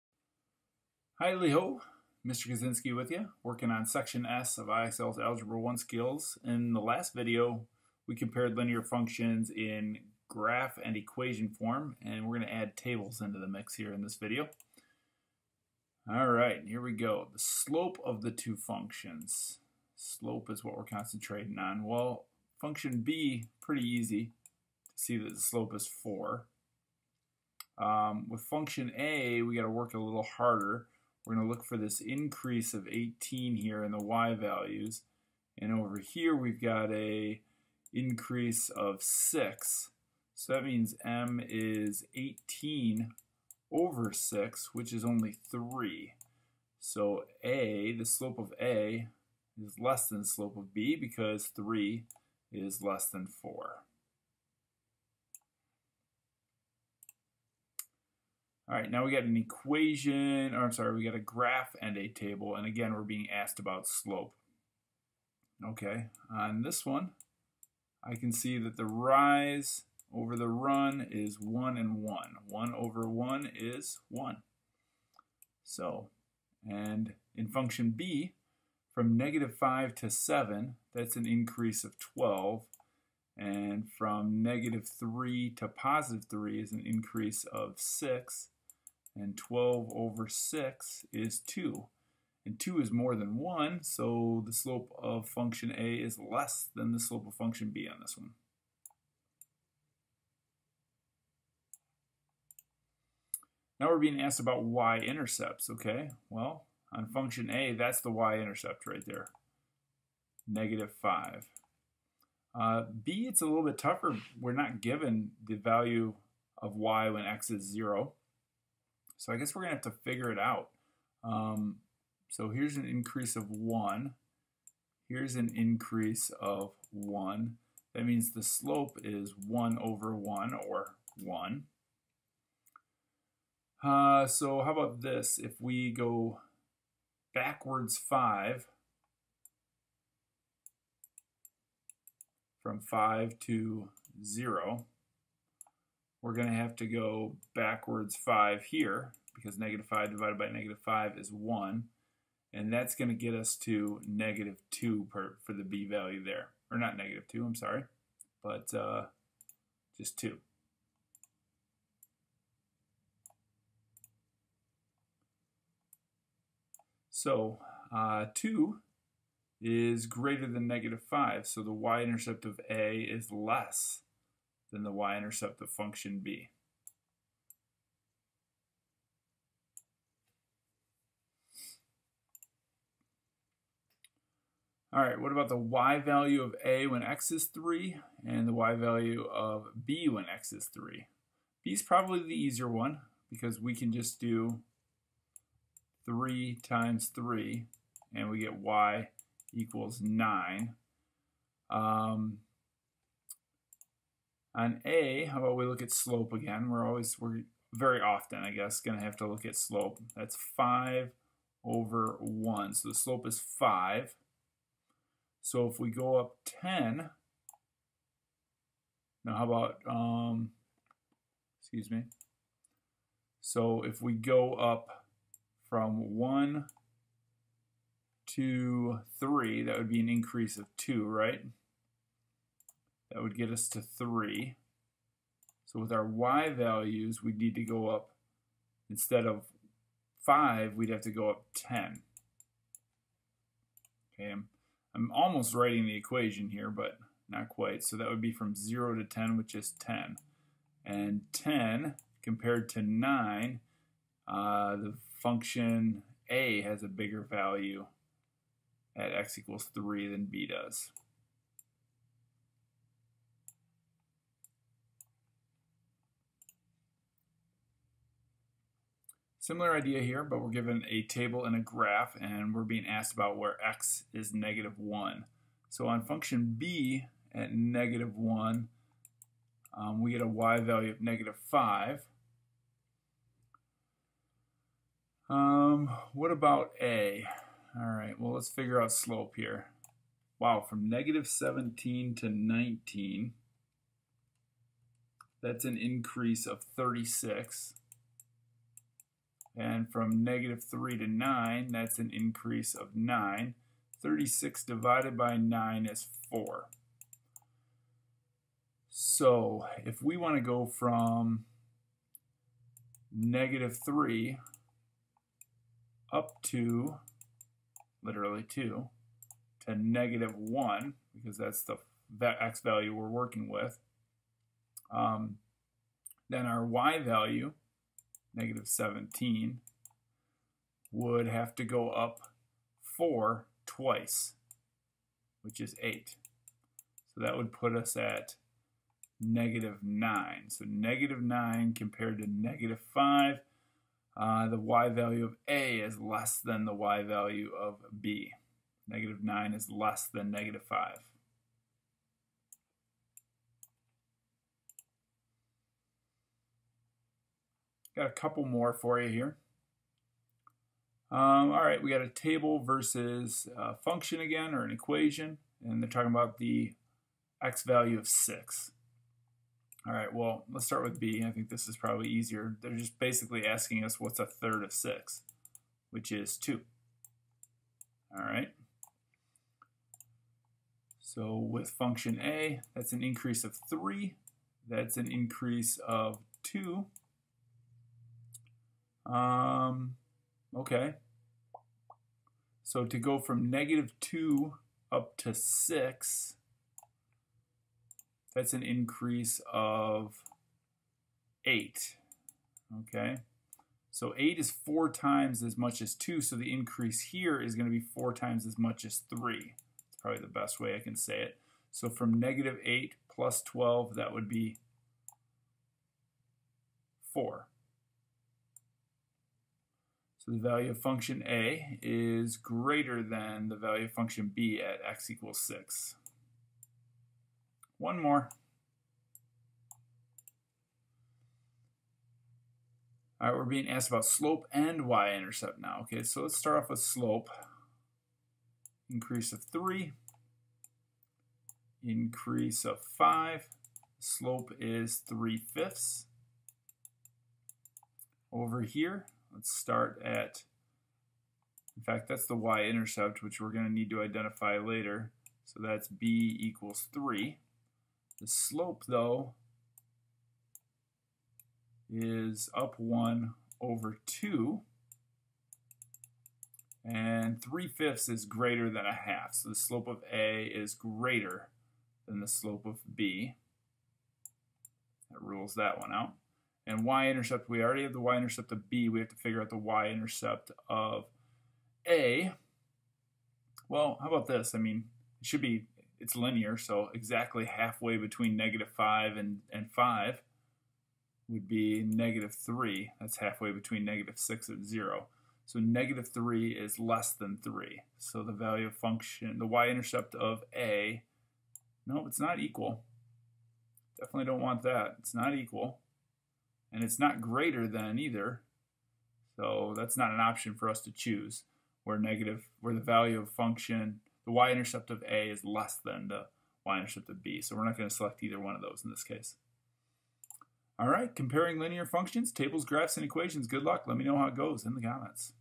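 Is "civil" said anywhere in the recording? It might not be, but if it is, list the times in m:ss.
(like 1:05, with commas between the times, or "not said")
not said.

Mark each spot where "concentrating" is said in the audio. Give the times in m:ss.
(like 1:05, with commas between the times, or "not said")
0:20.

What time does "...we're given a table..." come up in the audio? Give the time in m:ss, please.
4:30.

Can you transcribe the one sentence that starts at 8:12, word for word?
That's halfway between negative 6 and 0.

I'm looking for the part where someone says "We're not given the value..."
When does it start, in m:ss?
1:54.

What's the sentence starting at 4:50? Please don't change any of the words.
Wow, from negative 17 to 19, that's an increase of 36.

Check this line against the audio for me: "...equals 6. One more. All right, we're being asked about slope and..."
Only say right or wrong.
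right.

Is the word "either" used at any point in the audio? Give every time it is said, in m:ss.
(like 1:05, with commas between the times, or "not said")
8:27, 8:38.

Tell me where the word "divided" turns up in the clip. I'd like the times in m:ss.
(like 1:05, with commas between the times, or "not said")
2:30, 5:04.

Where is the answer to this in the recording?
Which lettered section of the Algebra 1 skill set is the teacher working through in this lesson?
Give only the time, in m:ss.
0:03.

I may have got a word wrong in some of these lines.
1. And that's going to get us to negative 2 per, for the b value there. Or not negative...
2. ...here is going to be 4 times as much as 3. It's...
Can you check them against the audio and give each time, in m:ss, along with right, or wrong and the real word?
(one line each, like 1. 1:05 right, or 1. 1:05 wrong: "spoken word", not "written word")
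1. 2:32 right
2. 6:47 right.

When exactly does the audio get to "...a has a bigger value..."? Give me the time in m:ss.
4:16.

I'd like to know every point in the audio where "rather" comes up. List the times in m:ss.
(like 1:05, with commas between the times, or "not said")
not said.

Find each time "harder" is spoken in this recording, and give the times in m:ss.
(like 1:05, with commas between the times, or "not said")
0:30.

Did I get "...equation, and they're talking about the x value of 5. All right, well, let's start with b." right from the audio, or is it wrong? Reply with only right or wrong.
wrong.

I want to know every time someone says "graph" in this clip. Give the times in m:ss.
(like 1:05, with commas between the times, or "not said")
0:10, 1:01, 4:31, 8:42.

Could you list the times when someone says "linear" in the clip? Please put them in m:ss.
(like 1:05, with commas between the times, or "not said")
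0:08, 8:06, 8:41.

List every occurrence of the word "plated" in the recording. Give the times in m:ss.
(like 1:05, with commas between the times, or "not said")
not said.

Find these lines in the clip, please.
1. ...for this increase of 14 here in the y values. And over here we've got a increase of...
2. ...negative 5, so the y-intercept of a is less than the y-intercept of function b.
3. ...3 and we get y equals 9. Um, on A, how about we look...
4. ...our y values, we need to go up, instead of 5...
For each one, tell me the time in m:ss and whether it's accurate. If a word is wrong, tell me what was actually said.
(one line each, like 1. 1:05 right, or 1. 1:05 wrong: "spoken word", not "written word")
1. 0:31 wrong: "18", not "14"
2. 2:50 right
3. 3:17 right
4. 3:55 right.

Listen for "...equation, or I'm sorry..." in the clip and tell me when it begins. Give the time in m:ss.
0:59.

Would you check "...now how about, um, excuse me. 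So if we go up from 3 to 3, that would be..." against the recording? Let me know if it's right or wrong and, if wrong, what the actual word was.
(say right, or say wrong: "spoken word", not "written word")
wrong: "1", not "3".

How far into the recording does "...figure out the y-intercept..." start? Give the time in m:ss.
7:59.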